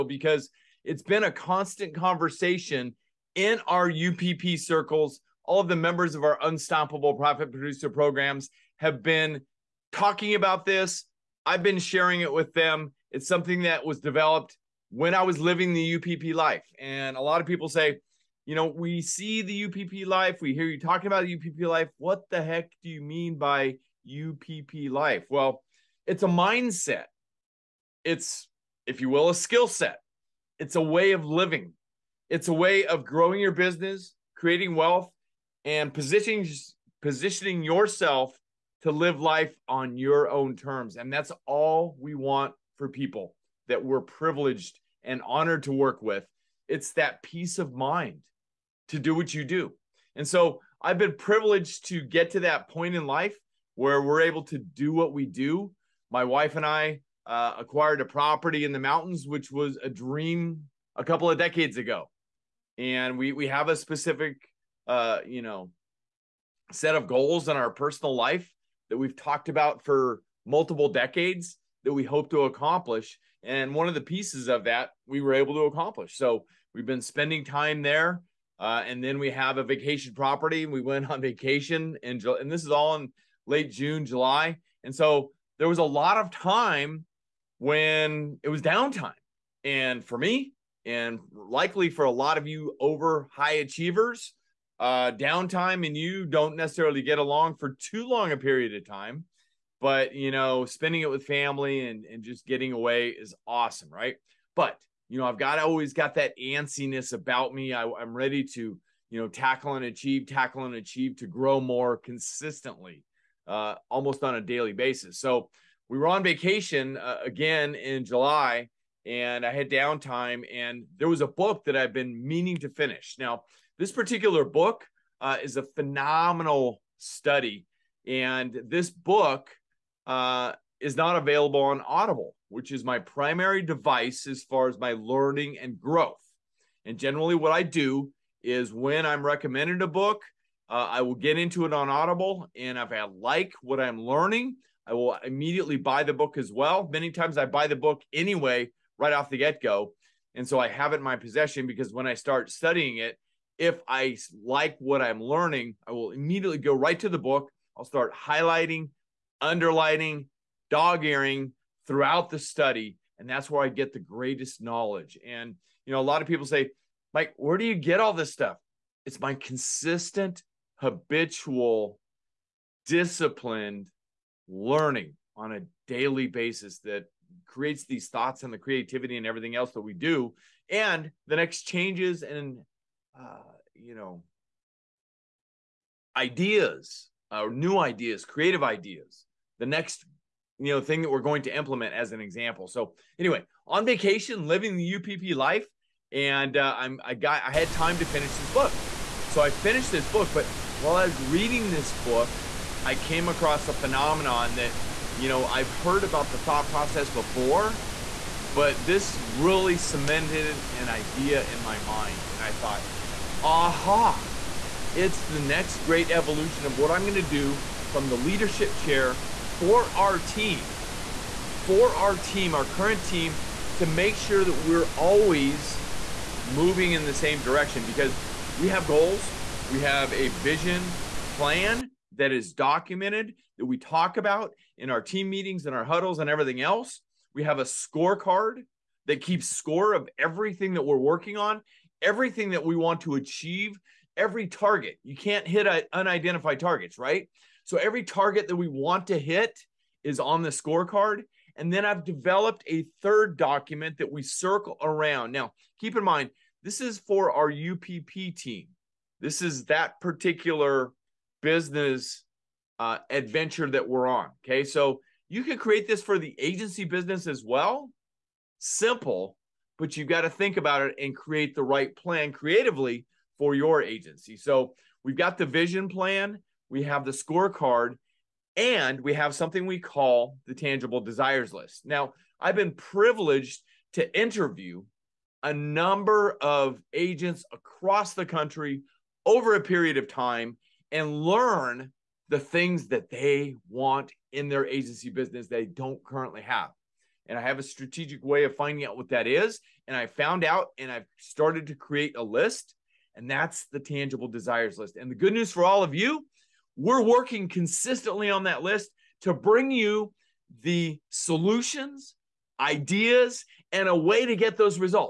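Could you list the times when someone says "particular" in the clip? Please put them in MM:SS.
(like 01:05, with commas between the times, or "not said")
02:03, 04:20.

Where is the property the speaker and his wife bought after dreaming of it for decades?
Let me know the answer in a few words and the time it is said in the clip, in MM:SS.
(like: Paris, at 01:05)
In the mountains, at 00:58.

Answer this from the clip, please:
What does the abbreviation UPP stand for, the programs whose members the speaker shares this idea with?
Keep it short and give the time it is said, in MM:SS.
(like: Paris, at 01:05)
Unstoppable Profit Producer, at 00:06.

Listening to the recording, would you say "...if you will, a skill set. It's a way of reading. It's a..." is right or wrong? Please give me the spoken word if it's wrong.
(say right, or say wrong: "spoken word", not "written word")
wrong: "living", not "reading".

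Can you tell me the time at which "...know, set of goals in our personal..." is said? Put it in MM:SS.
01:05.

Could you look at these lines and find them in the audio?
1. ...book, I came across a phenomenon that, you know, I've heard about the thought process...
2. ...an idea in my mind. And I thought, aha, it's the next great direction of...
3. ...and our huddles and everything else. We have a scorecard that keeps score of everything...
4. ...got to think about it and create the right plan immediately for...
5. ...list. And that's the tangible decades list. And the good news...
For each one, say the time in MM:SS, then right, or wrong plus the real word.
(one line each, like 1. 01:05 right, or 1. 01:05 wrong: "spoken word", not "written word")
1. 03:21 right
2. 03:30 wrong: "evolution", not "direction"
3. 03:55 right
4. 04:30 wrong: "creatively", not "immediately"
5. 05:02 wrong: "desires", not "decades".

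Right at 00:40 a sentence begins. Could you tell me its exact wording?
And that's all we want for people that we're privileged and honored to work with.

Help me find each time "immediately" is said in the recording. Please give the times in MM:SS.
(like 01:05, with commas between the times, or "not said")
02:25, 02:36.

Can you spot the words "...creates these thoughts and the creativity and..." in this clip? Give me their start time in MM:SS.
02:57.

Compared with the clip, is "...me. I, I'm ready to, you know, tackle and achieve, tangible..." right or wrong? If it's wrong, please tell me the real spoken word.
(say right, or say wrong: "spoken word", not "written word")
wrong: "tackle", not "tangible".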